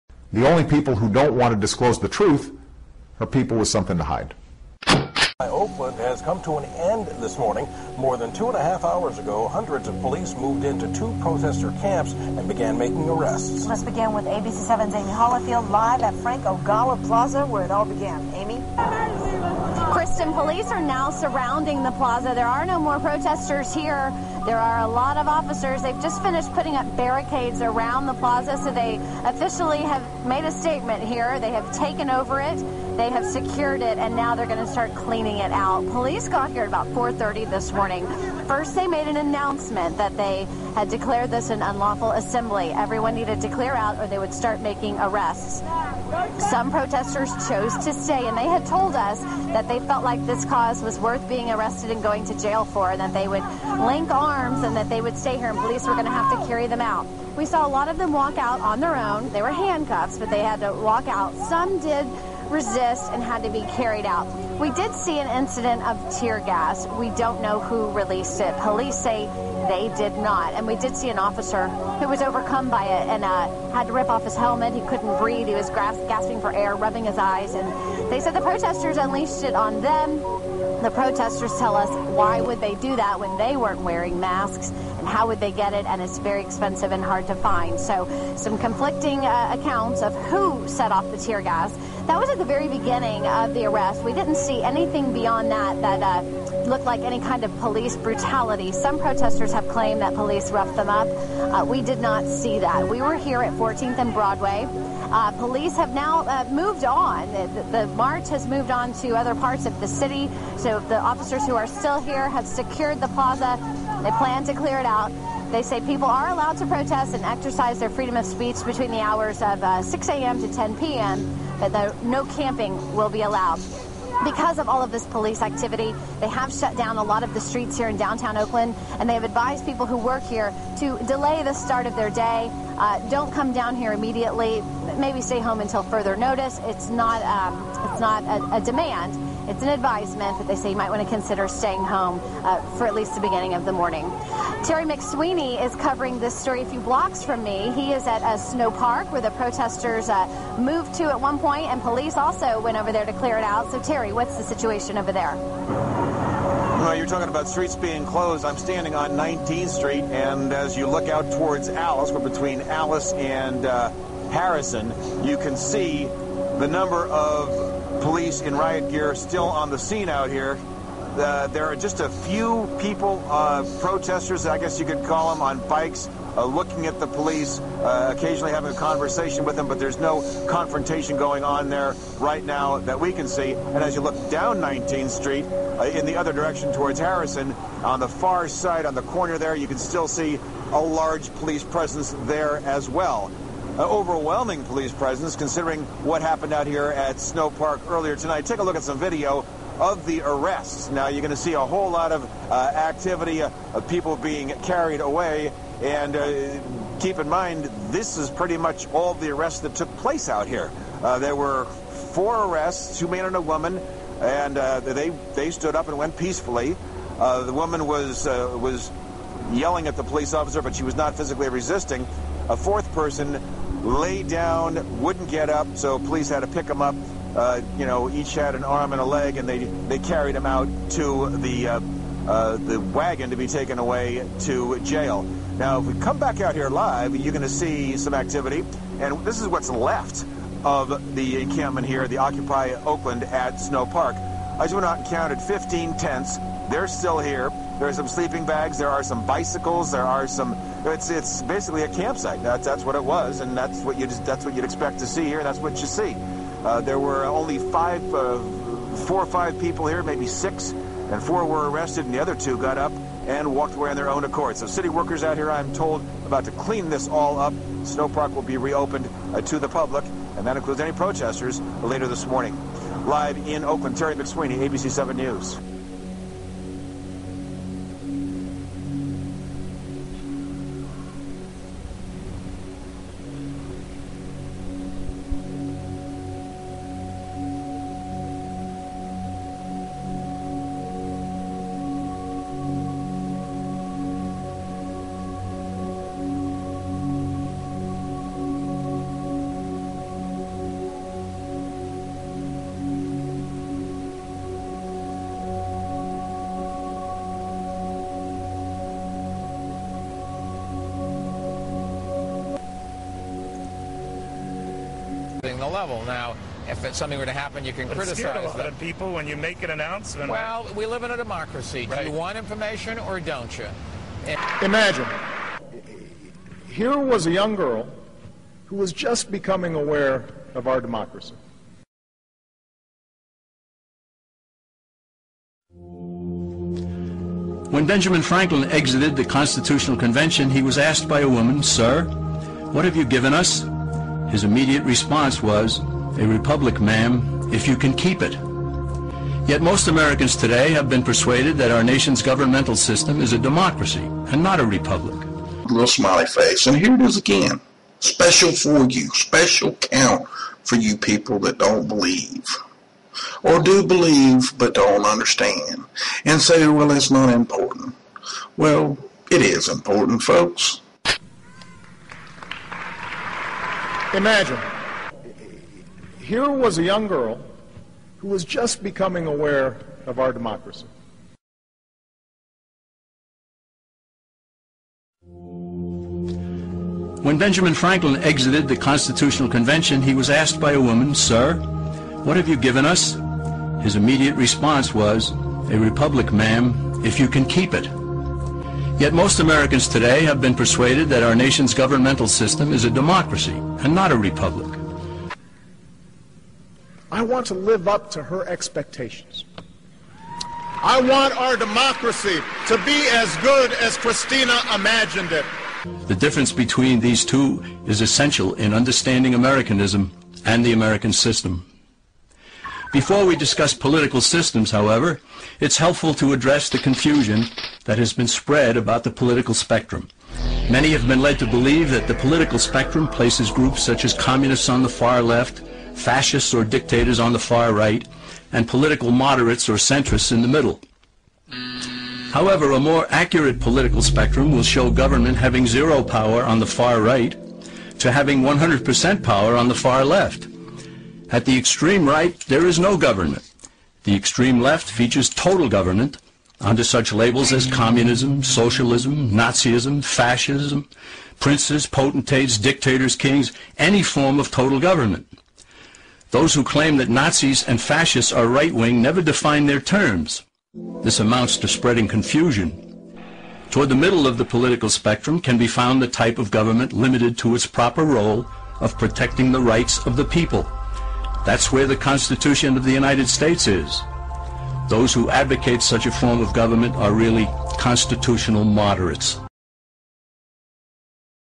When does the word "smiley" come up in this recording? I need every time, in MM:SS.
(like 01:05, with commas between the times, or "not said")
05:55.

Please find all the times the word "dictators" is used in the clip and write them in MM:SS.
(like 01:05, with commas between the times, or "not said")
07:16, 07:42.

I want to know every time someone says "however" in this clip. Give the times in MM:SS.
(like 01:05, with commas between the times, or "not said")
07:04, 07:22.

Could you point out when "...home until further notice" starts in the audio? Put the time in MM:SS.
02:15.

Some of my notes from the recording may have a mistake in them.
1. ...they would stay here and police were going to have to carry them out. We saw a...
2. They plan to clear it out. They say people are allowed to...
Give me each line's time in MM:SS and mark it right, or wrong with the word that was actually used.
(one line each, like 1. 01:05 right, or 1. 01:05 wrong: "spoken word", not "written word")
1. 00:54 right
2. 01:54 right.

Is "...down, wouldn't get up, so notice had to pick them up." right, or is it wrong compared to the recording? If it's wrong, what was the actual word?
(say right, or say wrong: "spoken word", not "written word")
wrong: "police", not "notice".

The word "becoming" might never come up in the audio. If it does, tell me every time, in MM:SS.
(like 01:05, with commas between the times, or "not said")
05:29, 06:18.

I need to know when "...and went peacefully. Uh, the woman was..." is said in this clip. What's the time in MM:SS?
03:35.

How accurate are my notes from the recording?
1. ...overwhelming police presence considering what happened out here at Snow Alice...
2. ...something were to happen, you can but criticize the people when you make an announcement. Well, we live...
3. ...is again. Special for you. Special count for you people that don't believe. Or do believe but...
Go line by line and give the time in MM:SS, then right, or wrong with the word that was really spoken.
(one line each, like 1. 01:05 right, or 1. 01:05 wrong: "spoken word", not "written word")
1. 03:13 wrong: "Park", not "Alice"
2. 05:16 right
3. 05:57 right.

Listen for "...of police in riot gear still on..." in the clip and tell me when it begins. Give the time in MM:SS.
02:47.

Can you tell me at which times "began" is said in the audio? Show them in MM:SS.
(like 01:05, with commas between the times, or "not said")
00:12, 00:17.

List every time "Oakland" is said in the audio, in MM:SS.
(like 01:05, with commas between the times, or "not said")
00:05, 02:08, 04:02, 04:33.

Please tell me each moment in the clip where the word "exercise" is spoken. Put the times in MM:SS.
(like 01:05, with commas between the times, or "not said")
01:57.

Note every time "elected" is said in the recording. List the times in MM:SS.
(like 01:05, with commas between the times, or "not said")
not said.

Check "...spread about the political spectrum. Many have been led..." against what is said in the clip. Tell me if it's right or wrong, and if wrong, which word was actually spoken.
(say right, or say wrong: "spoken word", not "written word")
right.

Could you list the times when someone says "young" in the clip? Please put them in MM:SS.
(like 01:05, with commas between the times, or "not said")
05:27, 06:16.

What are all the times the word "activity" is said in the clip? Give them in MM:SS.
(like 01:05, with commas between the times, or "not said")
02:05, 03:22, 03:58.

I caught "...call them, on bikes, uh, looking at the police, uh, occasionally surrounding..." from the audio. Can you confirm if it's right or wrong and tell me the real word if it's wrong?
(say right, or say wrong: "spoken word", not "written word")
wrong: "having", not "surrounding".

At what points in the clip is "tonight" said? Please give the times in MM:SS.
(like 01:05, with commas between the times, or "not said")
03:18.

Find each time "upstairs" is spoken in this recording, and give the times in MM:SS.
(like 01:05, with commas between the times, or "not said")
not said.